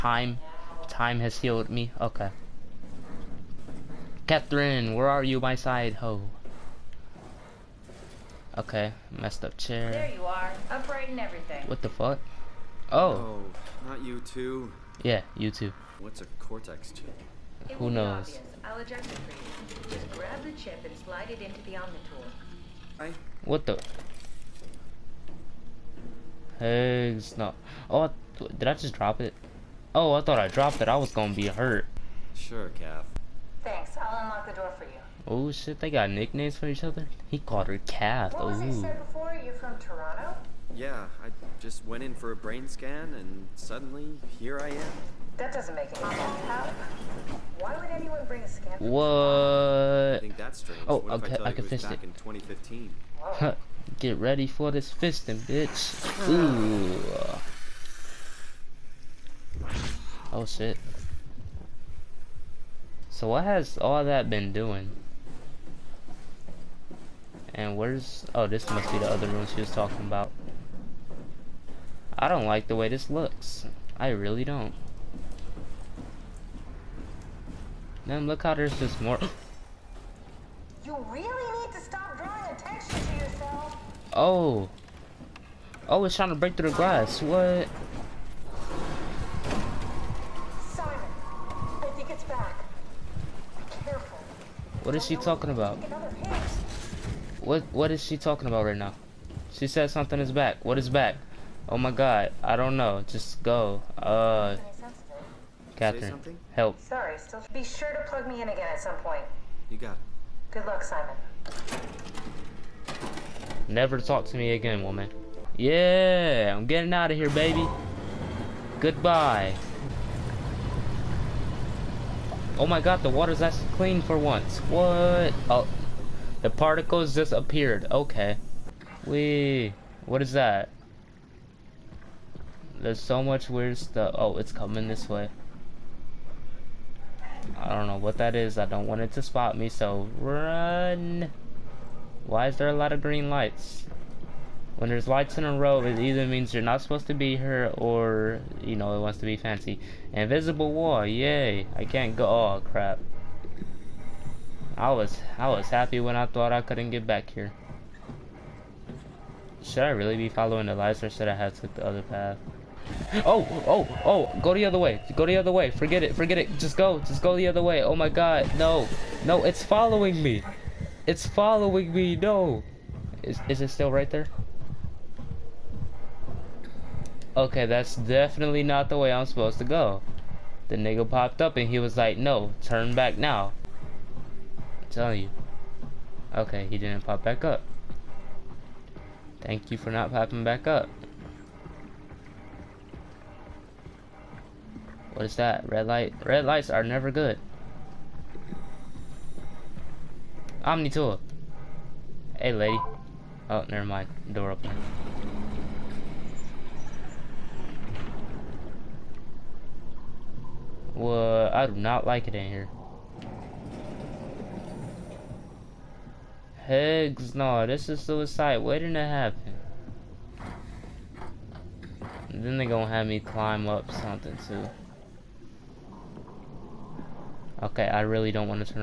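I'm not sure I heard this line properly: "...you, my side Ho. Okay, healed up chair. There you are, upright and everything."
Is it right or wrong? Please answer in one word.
wrong.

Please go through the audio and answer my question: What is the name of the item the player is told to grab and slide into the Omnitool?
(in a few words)
cortex chip.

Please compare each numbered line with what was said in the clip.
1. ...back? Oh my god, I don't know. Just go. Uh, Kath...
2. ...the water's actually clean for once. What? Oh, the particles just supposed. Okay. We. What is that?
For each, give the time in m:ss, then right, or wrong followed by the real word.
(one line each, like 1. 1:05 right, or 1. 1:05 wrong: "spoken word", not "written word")
1. 1:40 wrong: "Catherine", not "Kath"
2. 2:03 wrong: "appeared", not "supposed".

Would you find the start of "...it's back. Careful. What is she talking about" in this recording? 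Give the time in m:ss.
1:32.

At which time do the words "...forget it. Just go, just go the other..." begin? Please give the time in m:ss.
2:46.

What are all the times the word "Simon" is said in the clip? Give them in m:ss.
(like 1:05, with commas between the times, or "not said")
1:30, 1:50.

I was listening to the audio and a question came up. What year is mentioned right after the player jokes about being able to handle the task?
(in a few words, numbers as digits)
2015.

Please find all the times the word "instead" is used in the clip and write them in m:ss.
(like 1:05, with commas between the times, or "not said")
not said.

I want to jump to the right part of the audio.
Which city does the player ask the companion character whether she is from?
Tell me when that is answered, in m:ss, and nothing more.
0:39.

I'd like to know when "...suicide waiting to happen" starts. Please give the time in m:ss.
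3:38.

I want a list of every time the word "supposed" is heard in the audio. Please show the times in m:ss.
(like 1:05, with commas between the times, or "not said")
2:26, 2:59.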